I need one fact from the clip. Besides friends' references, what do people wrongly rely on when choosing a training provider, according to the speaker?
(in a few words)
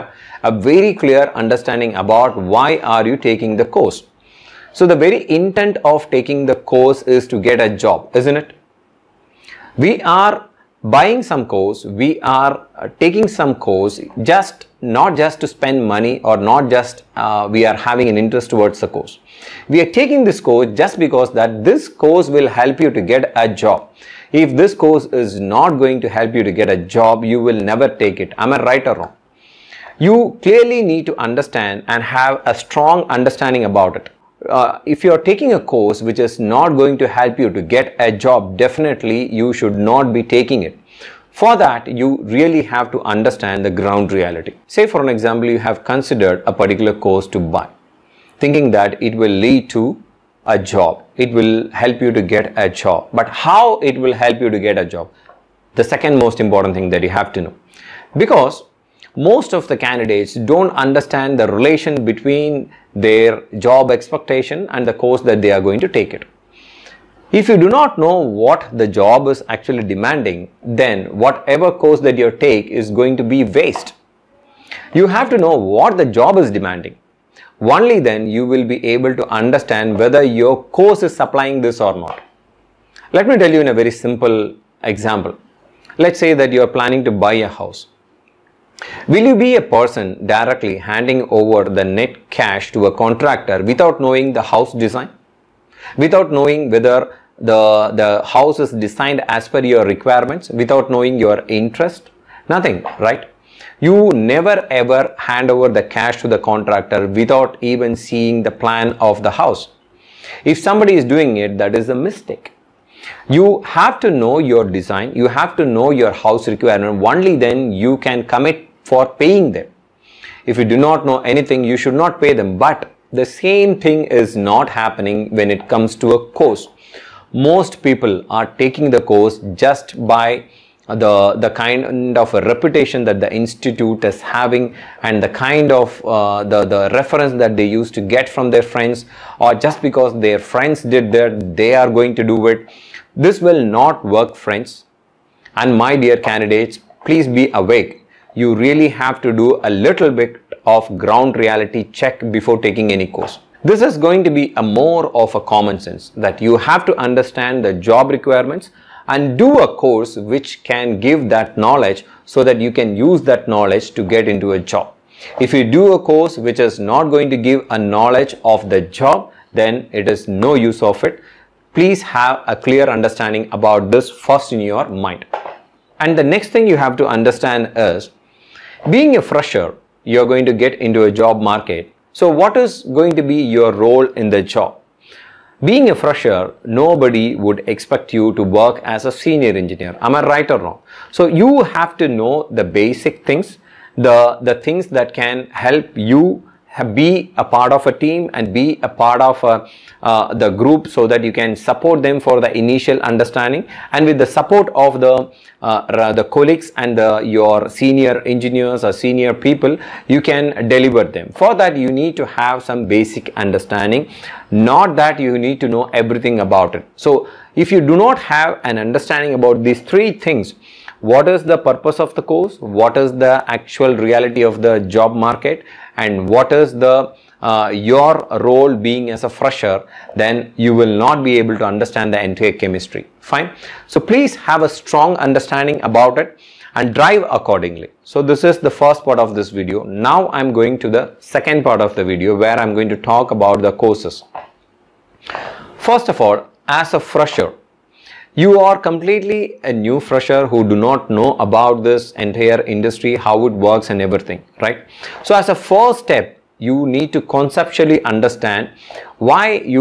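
Reputation.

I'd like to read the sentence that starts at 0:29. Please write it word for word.
You clearly need to understand and have a strong understanding about it.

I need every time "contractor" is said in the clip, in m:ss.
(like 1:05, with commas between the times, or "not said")
1:32, 1:46.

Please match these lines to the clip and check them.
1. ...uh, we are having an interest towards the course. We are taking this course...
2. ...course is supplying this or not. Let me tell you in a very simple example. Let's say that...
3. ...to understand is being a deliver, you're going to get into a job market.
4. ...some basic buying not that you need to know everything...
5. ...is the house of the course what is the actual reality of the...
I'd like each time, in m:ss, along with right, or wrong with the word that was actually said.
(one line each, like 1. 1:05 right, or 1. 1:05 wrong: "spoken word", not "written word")
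1. 0:17 right
2. 1:20 right
3. 2:56 wrong: "fresher", not "deliver"
4. 3:32 wrong: "understanding", not "buying"
5. 3:41 wrong: "purpose", not "house".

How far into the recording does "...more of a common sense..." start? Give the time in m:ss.
2:34.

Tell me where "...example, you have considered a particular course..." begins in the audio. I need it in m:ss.
0:45.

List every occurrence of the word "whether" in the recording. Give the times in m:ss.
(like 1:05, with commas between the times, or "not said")
1:19, 1:36.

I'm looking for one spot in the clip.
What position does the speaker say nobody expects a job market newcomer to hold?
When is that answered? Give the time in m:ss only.
3:09.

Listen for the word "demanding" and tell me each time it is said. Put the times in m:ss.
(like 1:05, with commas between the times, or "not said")
1:09, 1:16.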